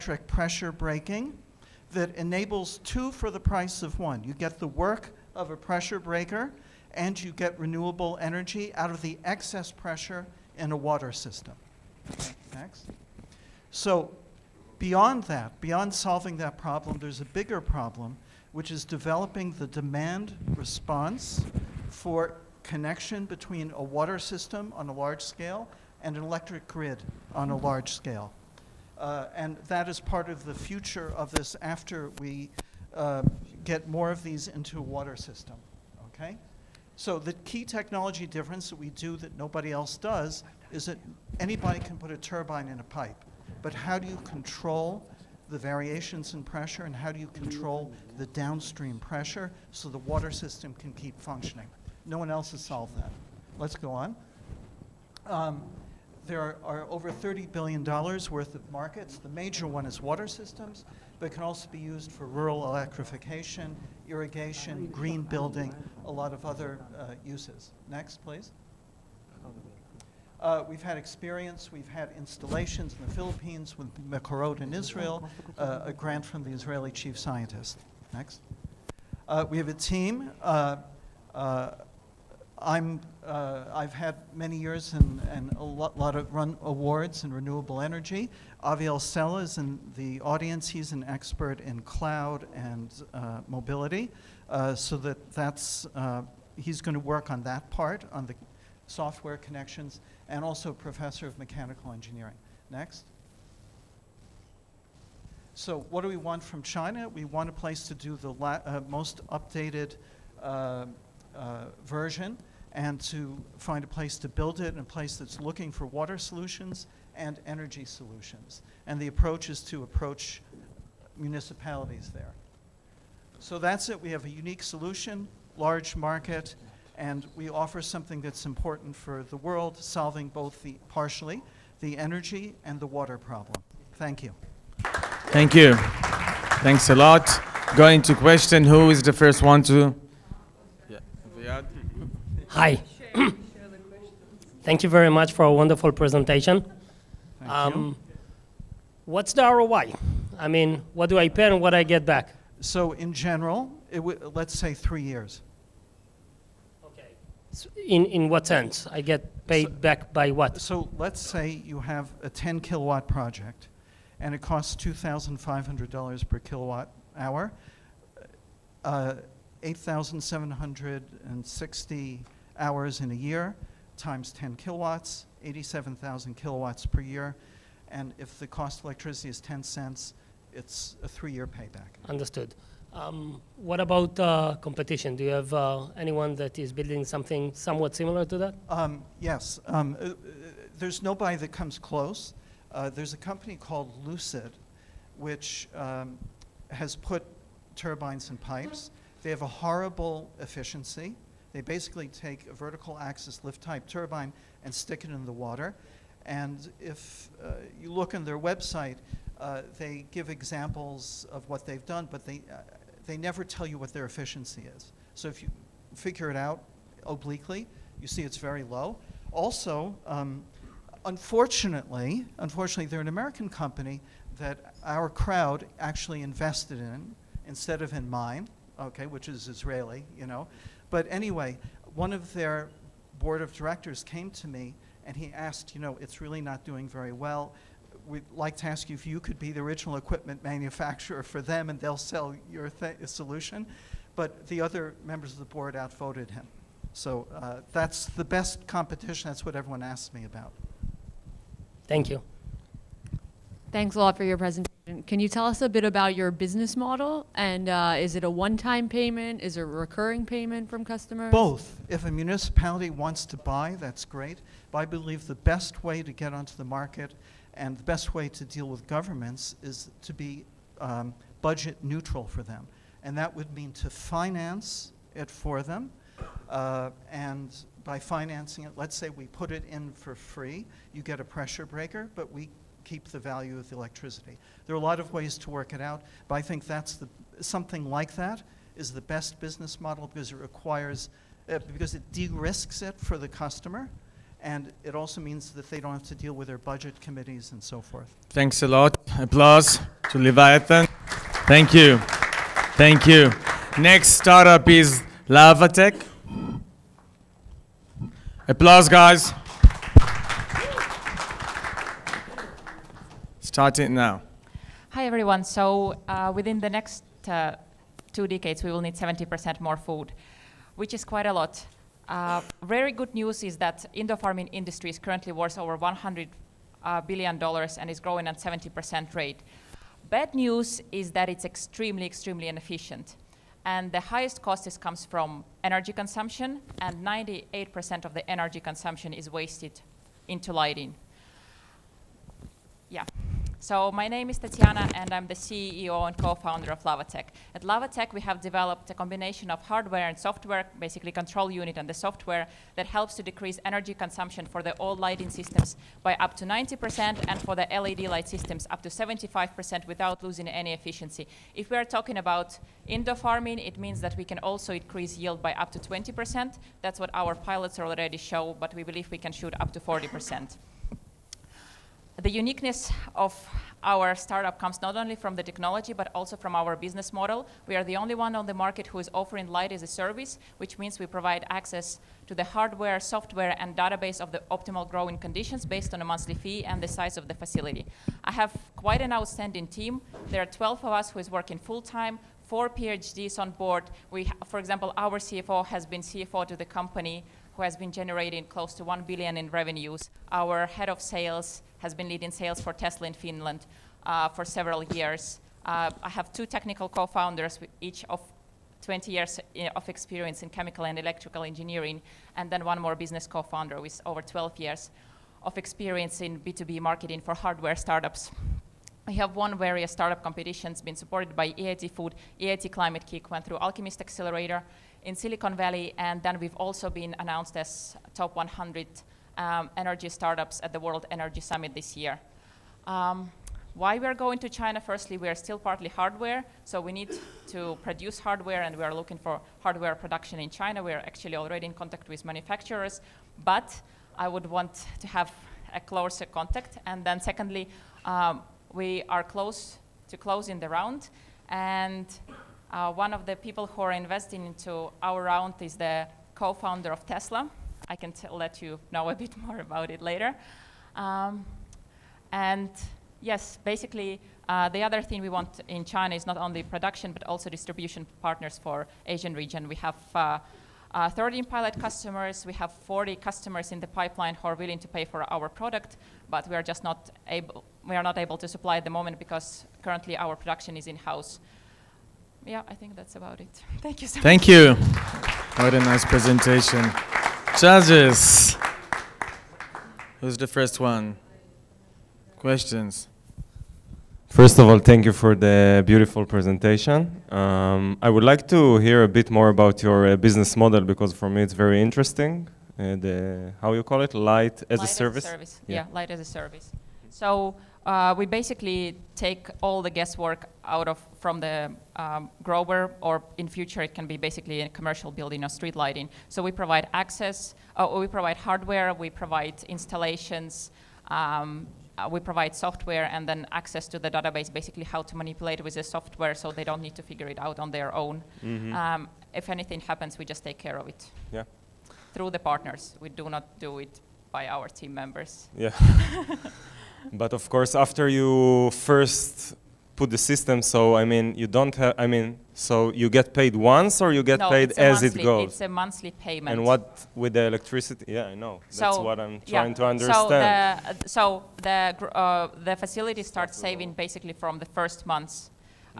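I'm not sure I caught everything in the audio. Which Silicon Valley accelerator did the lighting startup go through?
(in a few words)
Alchemist Accelerator.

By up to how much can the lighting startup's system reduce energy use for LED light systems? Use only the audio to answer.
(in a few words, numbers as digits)
75%.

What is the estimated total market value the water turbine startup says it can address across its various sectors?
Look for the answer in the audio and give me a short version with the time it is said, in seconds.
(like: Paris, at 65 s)
over $30 billion, at 56 s.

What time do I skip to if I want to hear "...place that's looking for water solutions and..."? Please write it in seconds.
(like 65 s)
114 s.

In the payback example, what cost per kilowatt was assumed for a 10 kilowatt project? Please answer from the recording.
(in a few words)
$2,500.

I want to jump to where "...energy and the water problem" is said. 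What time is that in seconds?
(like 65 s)
131 s.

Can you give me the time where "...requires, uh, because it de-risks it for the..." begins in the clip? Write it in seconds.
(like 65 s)
290 s.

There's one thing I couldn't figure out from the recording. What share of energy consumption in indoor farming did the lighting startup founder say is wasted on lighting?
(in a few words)
98%.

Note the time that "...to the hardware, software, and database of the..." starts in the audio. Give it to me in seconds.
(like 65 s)
382 s.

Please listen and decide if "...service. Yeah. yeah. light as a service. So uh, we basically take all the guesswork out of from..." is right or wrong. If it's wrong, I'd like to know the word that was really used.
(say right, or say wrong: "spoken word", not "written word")
right.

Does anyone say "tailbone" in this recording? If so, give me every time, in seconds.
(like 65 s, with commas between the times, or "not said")
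not said.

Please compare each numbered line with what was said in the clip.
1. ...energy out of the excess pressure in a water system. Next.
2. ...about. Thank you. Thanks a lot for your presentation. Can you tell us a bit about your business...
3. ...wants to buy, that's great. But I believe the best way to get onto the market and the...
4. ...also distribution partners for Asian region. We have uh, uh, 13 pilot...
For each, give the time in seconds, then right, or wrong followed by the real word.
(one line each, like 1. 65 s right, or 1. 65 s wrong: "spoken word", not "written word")
1. 8 s right
2. 250 s right
3. 262 s right
4. 467 s right.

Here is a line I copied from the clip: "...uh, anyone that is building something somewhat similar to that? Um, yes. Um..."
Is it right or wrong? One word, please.
right.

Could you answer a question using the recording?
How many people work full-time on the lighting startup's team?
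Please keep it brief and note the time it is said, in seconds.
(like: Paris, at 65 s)
12, at 390 s.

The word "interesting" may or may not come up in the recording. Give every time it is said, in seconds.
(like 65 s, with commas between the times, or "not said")
501 s.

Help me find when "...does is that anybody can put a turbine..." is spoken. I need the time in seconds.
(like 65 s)
39 s.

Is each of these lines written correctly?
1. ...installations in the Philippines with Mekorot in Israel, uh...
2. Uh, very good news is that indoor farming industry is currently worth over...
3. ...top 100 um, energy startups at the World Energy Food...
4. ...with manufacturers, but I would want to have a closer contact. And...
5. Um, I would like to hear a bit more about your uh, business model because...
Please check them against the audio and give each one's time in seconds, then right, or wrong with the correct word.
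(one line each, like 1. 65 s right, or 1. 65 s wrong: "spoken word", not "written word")
1. 72 s right
2. 322 s right
3. 428 s wrong: "Summit", not "Food"
4. 442 s right
5. 497 s right.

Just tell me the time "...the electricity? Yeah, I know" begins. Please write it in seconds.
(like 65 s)
547 s.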